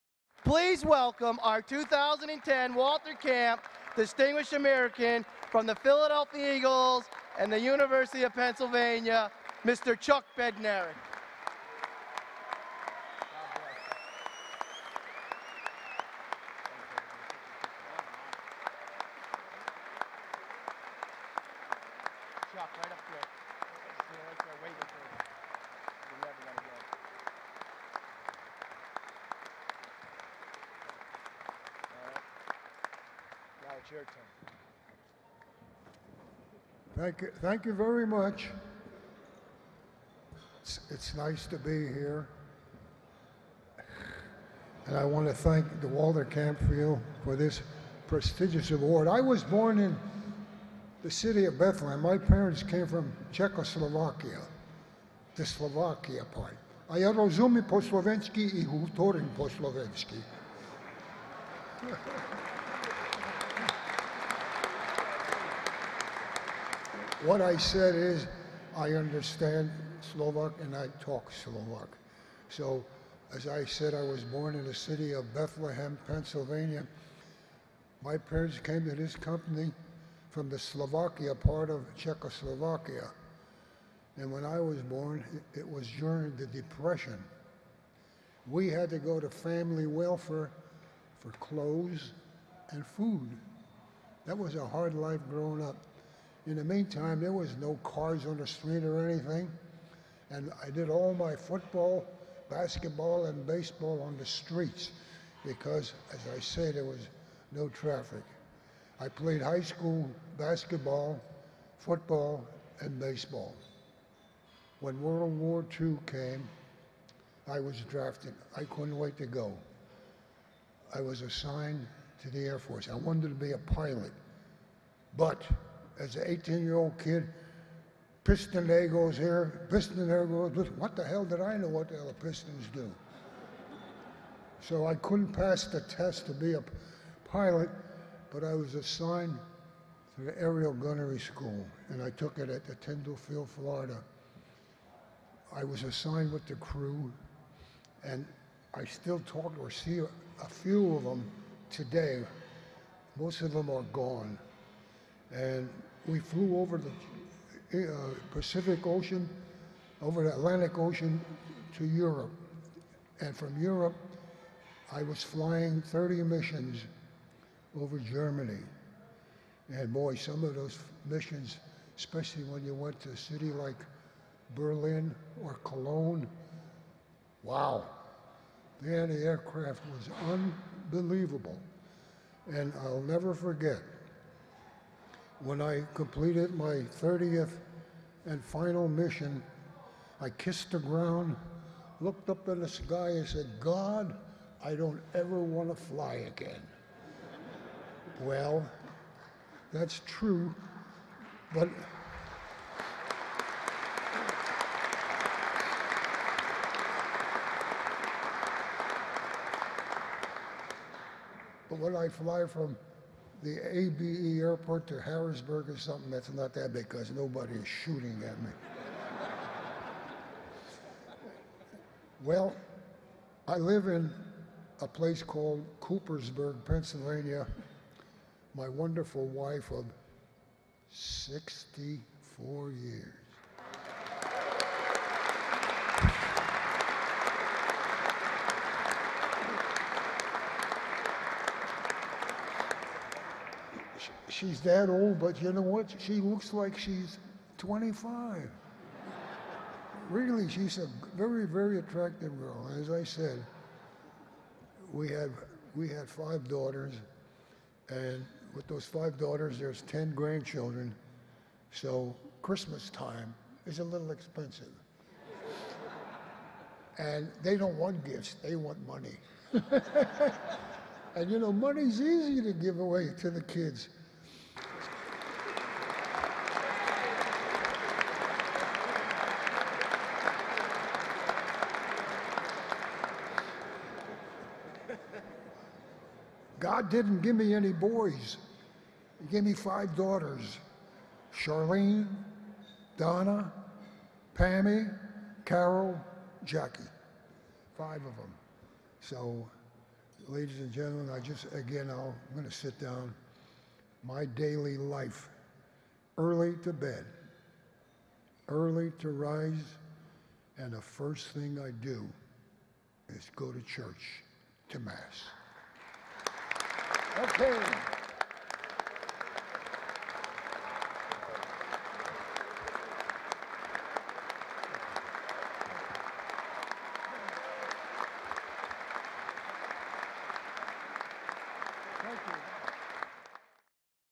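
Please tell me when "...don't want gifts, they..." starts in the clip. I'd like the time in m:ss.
4:27.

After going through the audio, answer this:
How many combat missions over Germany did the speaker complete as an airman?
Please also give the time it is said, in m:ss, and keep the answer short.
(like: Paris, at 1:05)
30, at 2:45.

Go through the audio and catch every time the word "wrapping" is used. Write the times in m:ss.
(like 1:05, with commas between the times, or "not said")
not said.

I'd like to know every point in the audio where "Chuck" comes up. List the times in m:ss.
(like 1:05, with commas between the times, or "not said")
0:09, 0:22.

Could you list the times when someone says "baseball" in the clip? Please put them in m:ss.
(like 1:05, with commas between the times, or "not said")
1:43, 1:52.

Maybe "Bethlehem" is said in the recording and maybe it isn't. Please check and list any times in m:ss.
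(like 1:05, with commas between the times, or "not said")
0:51, 1:15.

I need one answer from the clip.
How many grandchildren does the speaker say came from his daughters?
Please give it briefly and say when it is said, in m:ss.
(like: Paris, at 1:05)
10, at 4:19.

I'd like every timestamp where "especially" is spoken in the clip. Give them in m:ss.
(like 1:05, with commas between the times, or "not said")
2:51.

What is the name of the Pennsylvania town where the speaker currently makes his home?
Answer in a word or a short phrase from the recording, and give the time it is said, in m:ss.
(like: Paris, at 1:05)
Coopersburg, at 3:45.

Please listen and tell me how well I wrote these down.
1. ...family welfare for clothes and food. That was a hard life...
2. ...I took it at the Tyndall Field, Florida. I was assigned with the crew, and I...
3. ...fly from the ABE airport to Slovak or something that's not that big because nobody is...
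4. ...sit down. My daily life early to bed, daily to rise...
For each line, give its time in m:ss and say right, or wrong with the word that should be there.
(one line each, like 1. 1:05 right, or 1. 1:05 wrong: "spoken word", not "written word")
1. 1:29 right
2. 2:22 right
3. 3:32 wrong: "Harrisburg", not "Slovak"
4. 5:02 wrong: "early", not "daily".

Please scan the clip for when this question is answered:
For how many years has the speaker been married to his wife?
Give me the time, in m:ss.
3:50.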